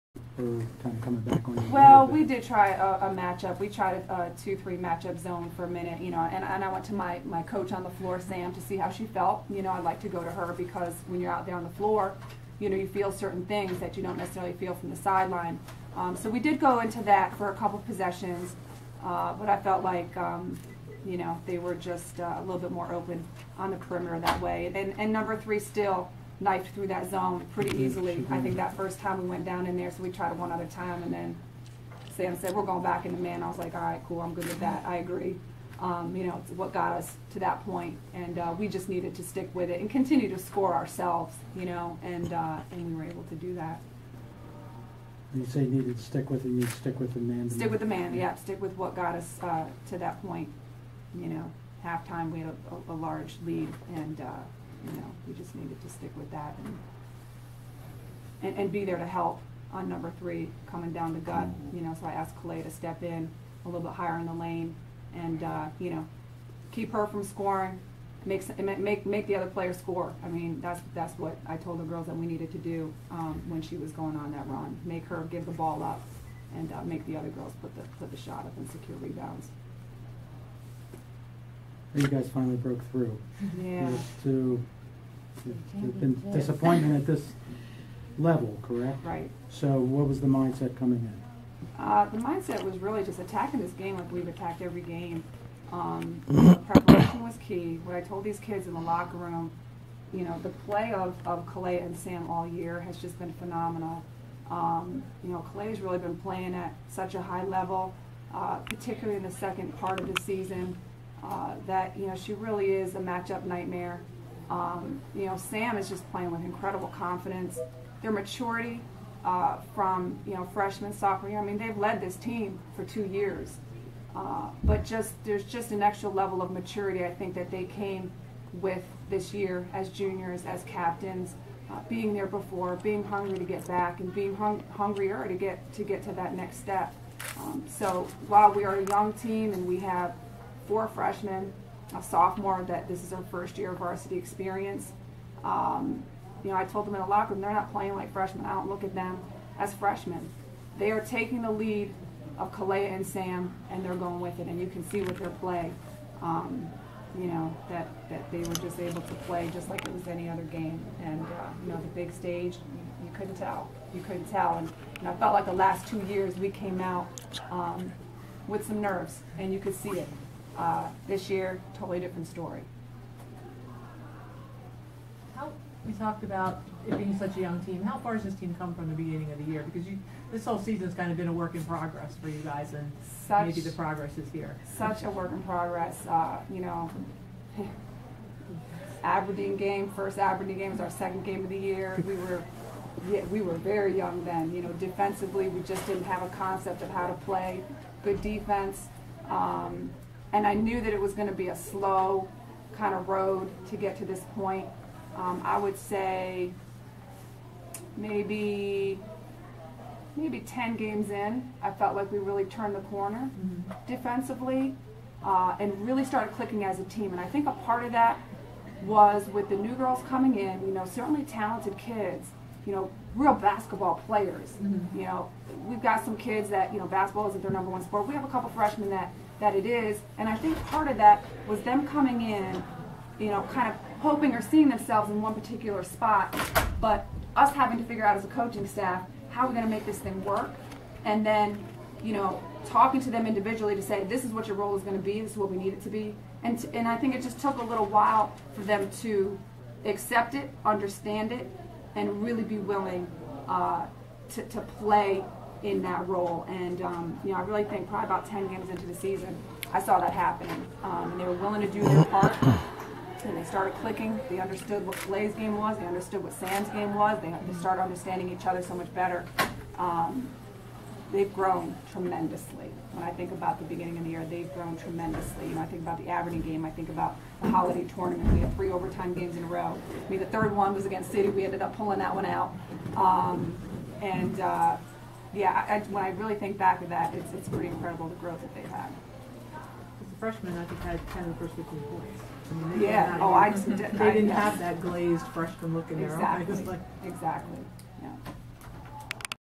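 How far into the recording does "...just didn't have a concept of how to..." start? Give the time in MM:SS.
03:15.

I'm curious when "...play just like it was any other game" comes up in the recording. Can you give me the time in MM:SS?
02:39.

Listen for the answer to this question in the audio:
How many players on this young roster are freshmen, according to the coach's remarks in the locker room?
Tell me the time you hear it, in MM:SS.
02:20.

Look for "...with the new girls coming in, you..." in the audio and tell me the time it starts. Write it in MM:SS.
03:39.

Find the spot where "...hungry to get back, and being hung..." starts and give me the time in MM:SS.
02:13.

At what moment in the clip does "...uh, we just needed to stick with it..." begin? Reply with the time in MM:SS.
00:38.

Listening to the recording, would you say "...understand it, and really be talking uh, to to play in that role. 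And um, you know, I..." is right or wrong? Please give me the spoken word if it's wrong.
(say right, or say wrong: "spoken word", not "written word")
wrong: "willing", not "talking".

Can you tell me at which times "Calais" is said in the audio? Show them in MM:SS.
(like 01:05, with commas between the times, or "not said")
01:41, 01:45.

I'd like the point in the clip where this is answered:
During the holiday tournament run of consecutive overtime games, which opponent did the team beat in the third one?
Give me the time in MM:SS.
04:41.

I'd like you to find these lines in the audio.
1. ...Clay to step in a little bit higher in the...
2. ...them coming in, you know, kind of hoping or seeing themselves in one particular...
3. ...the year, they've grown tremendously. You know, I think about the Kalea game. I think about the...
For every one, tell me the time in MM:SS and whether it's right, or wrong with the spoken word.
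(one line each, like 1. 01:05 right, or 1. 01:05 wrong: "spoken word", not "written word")
1. 01:02 right
2. 03:51 right
3. 04:34 wrong: "Aberdeen", not "Kalea".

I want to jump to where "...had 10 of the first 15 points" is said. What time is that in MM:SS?
04:50.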